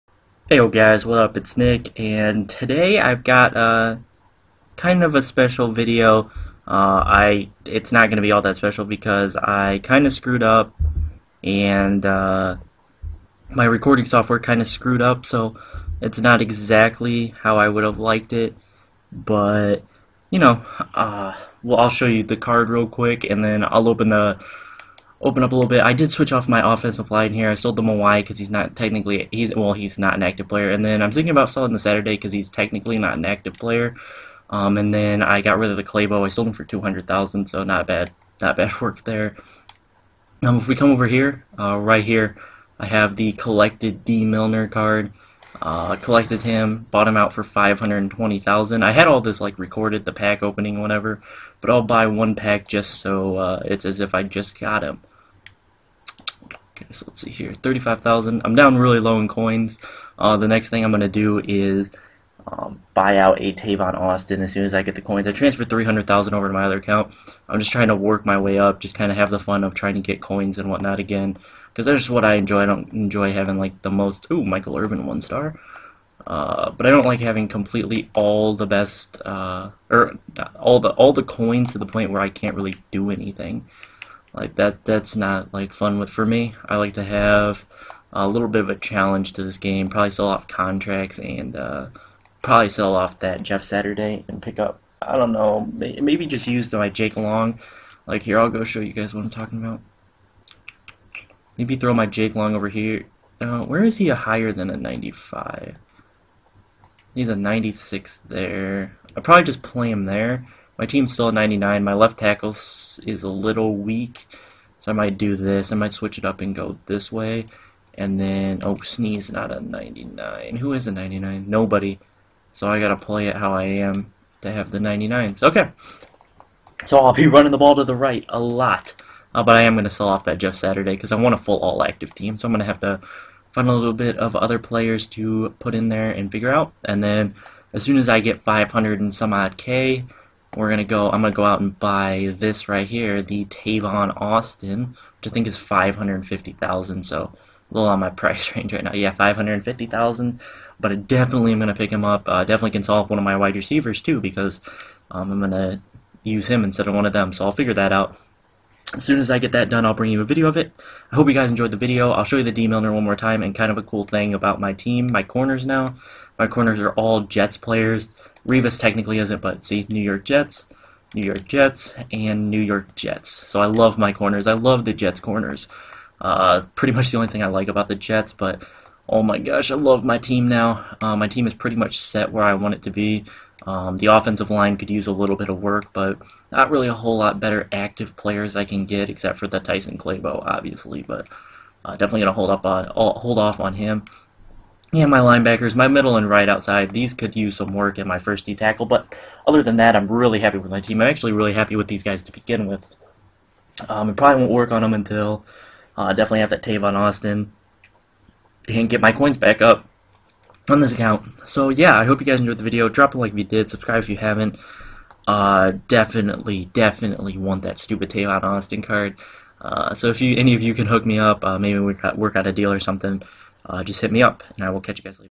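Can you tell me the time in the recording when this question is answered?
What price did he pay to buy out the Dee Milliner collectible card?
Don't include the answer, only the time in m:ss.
0:47.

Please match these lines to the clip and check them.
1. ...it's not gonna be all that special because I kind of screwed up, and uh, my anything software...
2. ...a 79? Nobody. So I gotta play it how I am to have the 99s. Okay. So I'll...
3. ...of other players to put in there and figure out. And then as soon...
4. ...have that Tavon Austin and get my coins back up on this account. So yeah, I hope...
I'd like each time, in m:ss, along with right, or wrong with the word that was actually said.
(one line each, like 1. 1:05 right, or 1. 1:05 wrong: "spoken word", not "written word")
1. 0:07 wrong: "recording", not "anything"
2. 2:00 wrong: "99", not "79"
3. 2:14 right
4. 3:26 right.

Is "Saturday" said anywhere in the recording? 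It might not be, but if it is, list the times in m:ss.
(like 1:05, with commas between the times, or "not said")
0:31, 1:33, 2:10.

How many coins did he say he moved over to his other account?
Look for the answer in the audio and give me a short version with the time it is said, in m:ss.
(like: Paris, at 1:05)
300,000, at 1:05.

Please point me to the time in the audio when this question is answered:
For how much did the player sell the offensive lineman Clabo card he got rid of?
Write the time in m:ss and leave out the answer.
0:36.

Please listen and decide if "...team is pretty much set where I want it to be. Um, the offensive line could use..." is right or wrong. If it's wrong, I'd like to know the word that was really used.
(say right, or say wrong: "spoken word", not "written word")
right.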